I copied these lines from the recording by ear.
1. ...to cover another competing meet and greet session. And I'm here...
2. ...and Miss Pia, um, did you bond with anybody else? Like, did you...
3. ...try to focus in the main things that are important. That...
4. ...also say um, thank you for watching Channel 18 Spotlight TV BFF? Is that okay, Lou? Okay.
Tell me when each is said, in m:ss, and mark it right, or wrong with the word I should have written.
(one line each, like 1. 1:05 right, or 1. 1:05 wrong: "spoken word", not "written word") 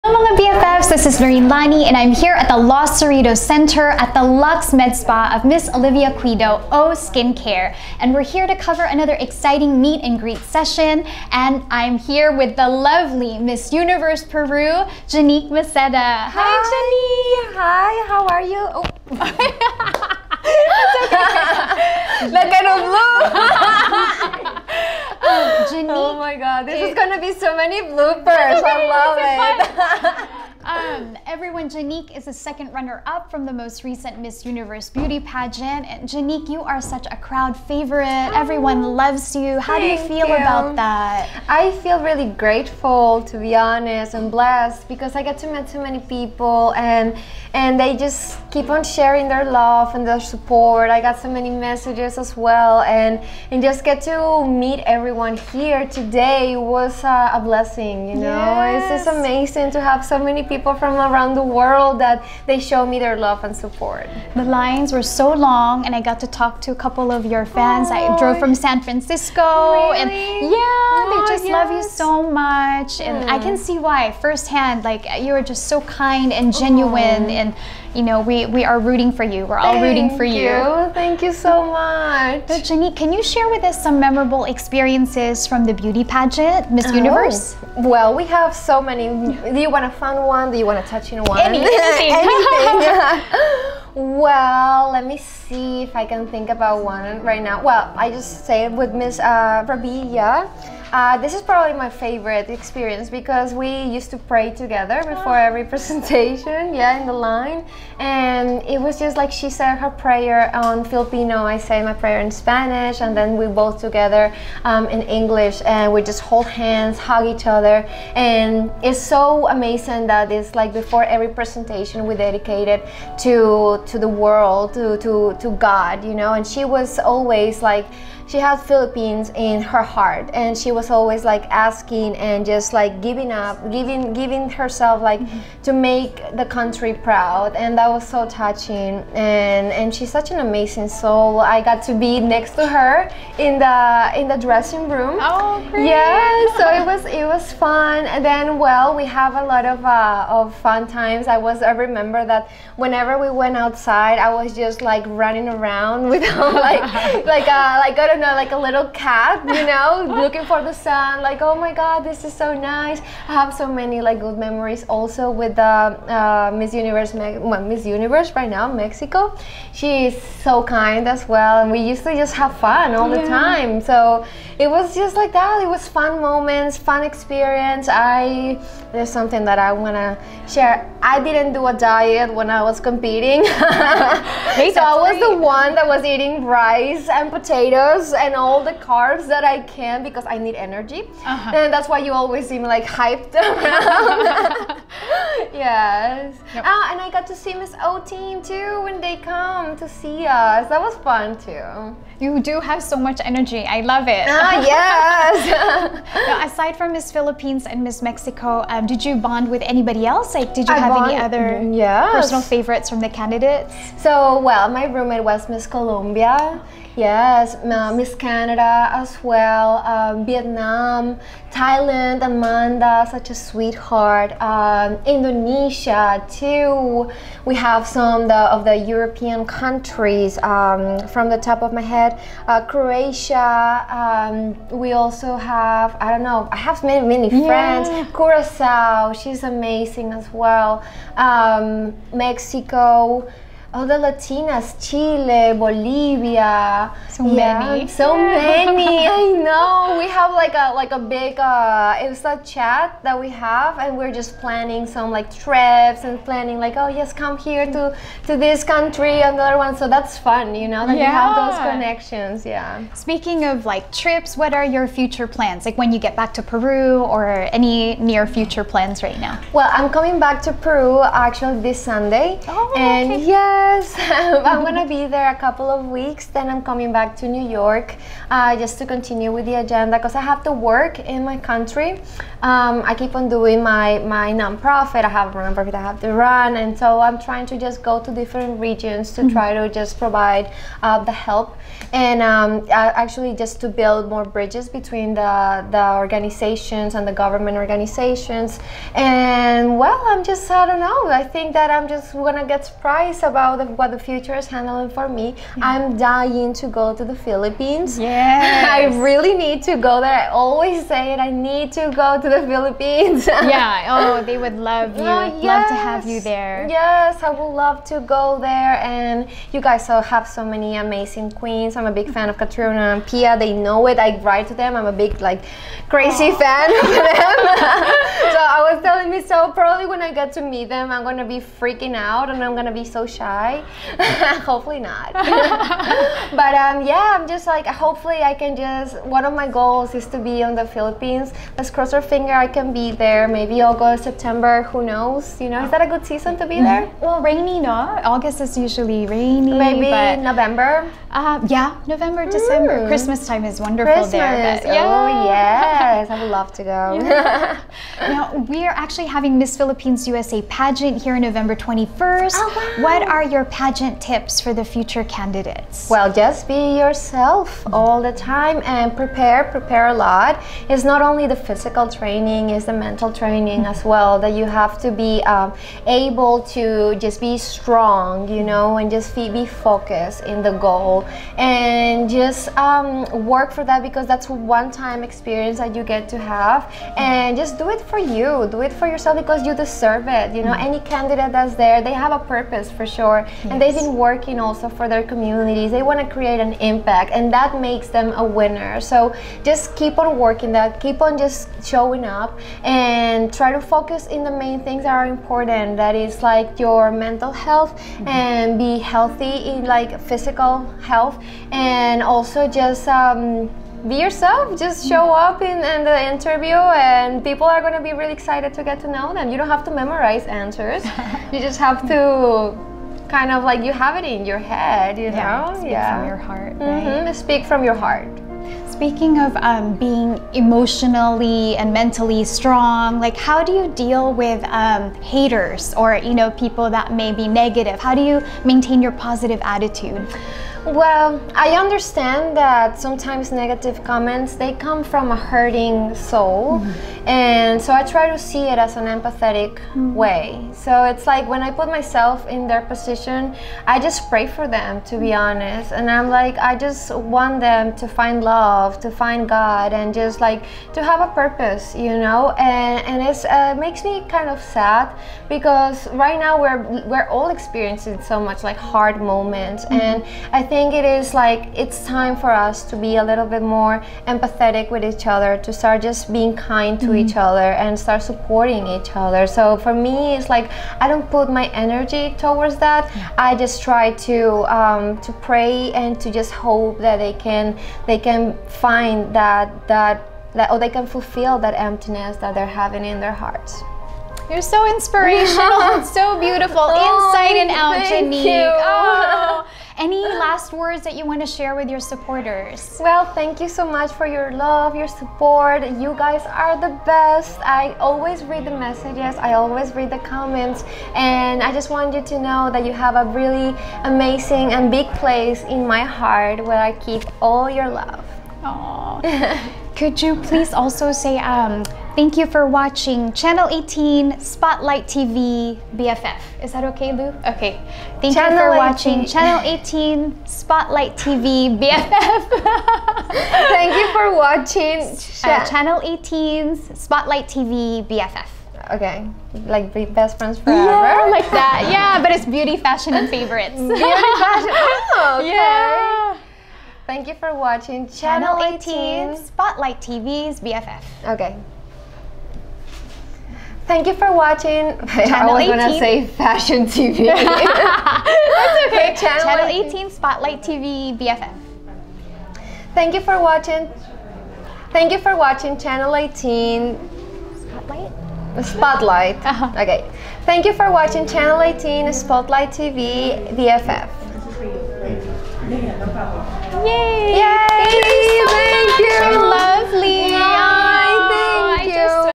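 1. 0:08 wrong: "exciting", not "competing"
2. 3:27 wrong: "Mexico", not "Pia"
3. 6:43 right
4. 8:40 right.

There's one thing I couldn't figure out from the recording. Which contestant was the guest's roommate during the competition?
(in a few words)
Miss Colombia.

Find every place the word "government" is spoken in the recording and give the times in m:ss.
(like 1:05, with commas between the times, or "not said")
4:57.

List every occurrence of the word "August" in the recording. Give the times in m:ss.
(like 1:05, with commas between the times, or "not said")
5:43, 5:48.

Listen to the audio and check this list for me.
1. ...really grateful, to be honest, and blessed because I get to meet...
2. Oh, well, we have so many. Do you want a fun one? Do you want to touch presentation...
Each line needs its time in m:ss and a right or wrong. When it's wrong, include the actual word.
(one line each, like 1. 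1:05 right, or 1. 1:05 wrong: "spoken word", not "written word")
1. 0:42 right
2. 1:27 wrong: "question", not "presentation".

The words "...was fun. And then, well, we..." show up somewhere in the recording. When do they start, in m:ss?
2:27.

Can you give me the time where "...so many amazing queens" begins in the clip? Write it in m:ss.
5:20.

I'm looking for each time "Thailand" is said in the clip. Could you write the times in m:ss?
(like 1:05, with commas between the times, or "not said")
3:41.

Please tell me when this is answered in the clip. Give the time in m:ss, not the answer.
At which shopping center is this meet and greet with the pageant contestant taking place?
0:02.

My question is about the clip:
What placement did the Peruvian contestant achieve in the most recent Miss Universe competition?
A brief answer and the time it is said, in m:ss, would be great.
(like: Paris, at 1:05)
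Second runner-up, at 0:32.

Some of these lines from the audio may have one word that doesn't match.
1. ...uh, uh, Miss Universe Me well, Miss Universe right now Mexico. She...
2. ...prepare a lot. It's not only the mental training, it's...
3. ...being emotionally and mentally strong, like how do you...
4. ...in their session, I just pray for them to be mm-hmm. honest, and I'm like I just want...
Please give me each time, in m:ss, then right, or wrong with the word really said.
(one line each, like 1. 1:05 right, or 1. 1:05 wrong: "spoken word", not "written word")
1. 2:45 right
2. 6:09 wrong: "physical", not "mental"
3. 7:09 right
4. 7:32 wrong: "position", not "session".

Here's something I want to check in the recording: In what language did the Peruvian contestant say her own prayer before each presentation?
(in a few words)
Spanish.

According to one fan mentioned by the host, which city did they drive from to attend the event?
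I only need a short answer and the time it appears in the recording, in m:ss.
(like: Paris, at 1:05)
San Francisco, at 1:08.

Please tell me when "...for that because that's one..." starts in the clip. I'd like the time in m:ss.
6:23.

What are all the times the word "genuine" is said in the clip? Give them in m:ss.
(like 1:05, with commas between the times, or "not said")
1:16.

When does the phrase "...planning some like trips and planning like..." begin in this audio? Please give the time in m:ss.
4:14.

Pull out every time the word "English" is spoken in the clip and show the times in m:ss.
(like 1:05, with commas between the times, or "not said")
1:55.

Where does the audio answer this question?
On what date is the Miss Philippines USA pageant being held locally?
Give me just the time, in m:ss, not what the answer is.
6:01.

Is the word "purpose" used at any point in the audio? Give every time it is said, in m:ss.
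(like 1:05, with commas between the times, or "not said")
6:32, 7:41.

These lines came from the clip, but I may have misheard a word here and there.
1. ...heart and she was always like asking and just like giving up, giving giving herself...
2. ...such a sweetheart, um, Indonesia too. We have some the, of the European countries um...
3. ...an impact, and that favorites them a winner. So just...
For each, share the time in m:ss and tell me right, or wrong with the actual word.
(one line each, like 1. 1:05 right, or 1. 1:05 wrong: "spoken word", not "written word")
1. 2:09 right
2. 3:43 right
3. 6:36 wrong: "makes", not "favorites".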